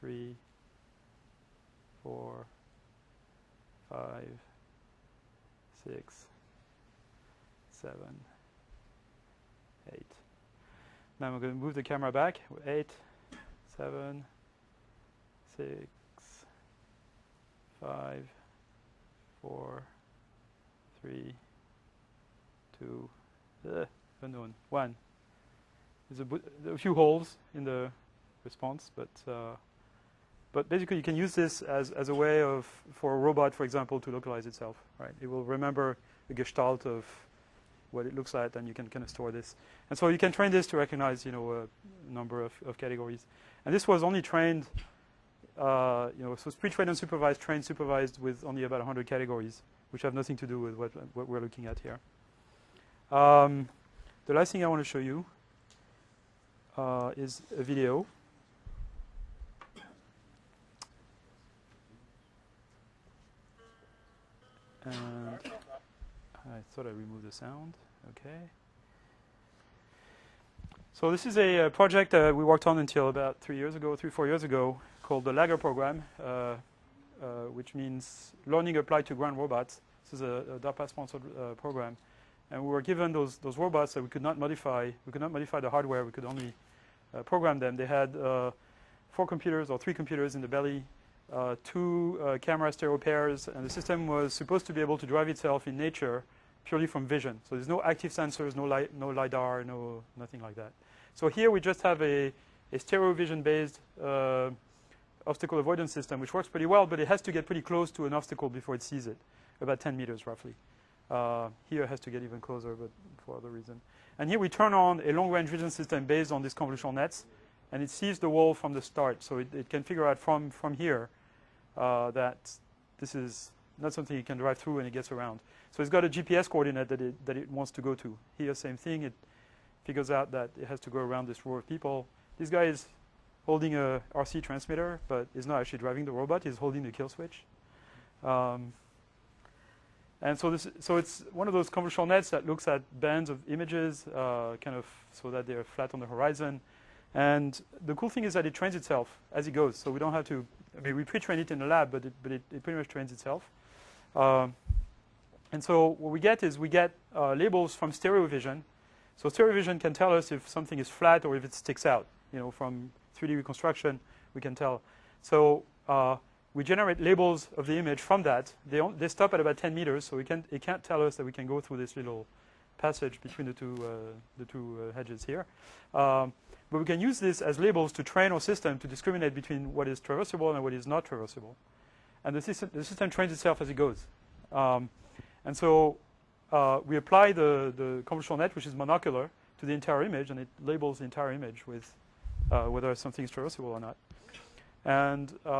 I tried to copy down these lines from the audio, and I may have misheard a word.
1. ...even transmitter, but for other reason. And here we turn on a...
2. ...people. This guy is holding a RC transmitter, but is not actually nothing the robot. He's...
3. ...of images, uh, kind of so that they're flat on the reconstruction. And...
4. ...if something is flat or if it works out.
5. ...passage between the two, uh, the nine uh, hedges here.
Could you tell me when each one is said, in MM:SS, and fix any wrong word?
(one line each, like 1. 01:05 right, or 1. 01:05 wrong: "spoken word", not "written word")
1. 01:52 wrong: "closer", not "transmitter"
2. 02:11 wrong: "driving", not "nothing"
3. 02:23 wrong: "horizon", not "reconstruction"
4. 02:40 wrong: "sticks", not "works"
5. 02:52 wrong: "two", not "nine".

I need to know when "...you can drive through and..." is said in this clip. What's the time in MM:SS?
02:04.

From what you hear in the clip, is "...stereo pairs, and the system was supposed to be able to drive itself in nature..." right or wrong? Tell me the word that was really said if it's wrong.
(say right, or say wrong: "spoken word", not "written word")
right.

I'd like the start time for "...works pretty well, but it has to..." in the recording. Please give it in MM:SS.
01:46.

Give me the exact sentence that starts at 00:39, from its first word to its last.
And so you can train this to recognize, you know, a number of, of categories.